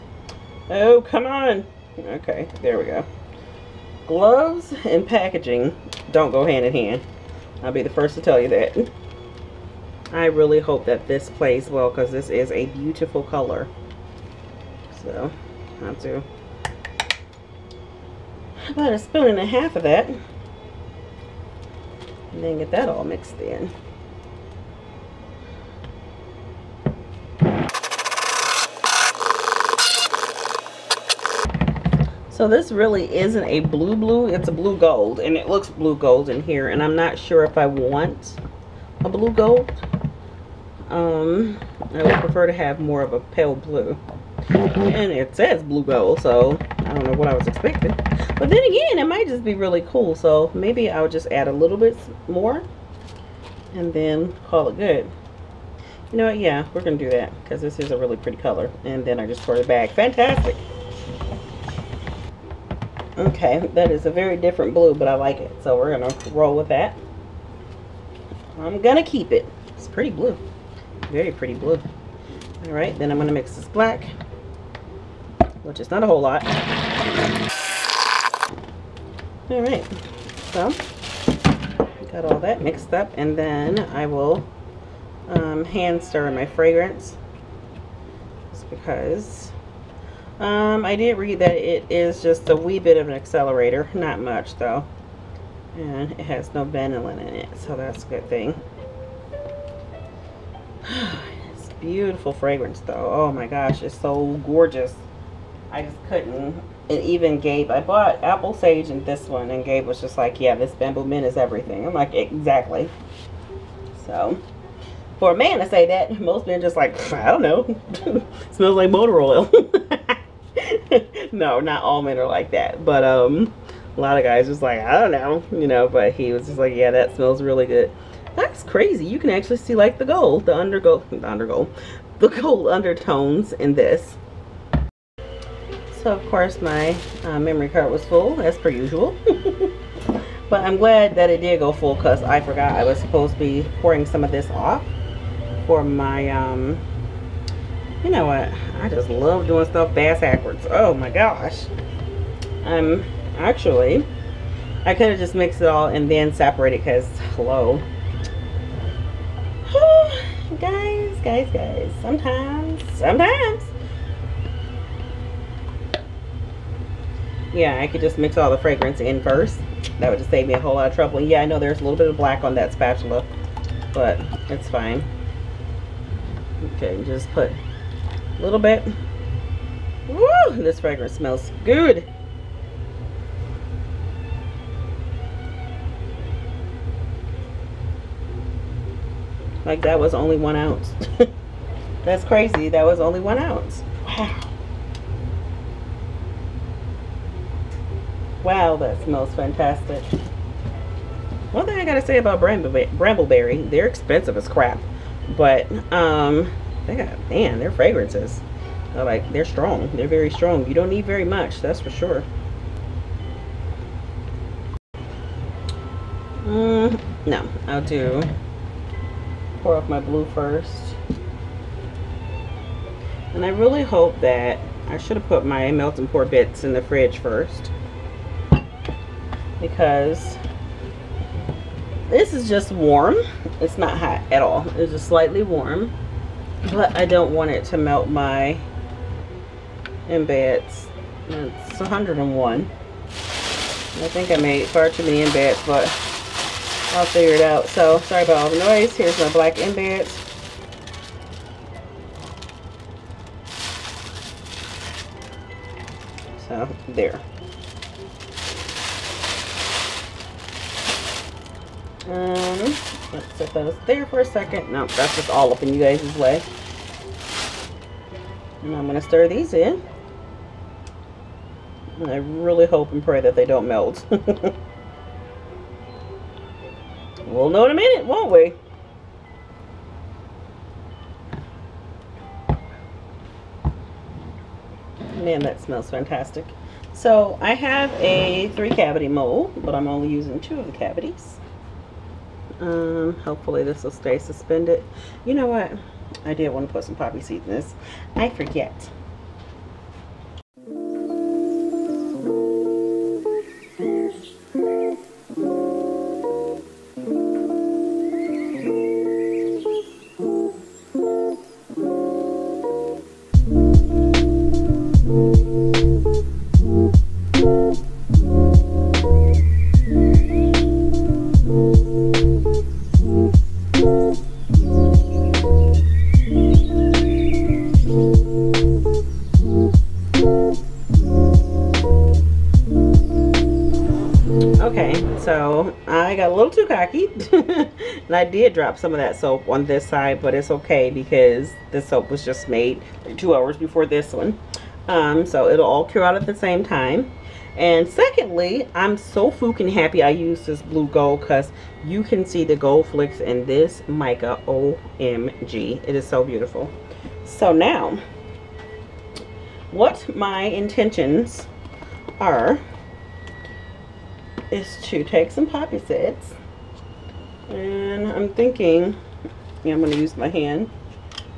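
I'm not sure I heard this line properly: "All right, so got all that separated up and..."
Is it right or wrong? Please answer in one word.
wrong.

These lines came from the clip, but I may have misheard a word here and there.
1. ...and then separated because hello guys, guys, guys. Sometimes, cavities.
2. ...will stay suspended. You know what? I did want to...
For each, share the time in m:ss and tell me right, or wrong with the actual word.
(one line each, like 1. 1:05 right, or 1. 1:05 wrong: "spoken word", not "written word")
1. 2:35 wrong: "sometimes", not "cavities"
2. 4:53 right.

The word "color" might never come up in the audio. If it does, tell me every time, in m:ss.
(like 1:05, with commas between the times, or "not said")
0:13, 0:58.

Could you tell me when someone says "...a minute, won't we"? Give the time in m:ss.
4:37.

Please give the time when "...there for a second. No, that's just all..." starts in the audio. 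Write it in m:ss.
4:23.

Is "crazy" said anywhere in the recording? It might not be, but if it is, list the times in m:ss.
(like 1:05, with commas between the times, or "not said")
2:08, 3:12.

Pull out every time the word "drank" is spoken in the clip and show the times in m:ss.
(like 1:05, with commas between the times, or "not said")
not said.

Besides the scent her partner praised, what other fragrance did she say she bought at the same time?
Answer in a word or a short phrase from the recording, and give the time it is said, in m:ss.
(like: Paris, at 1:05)
Apple Sage, at 1:48.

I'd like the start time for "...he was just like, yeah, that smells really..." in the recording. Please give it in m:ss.
2:06.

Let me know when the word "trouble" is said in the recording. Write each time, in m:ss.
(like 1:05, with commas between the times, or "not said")
2:50.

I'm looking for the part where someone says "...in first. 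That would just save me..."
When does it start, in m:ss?
2:49.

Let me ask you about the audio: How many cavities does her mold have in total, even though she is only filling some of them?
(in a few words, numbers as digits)
3.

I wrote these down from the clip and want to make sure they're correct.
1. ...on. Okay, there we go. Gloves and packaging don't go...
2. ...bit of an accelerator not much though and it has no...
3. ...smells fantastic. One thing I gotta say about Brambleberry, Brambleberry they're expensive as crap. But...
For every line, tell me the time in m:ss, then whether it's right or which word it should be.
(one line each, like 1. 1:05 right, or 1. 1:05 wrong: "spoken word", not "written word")
1. 0:01 right
2. 1:32 right
3. 3:19 right.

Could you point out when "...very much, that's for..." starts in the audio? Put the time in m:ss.
3:31.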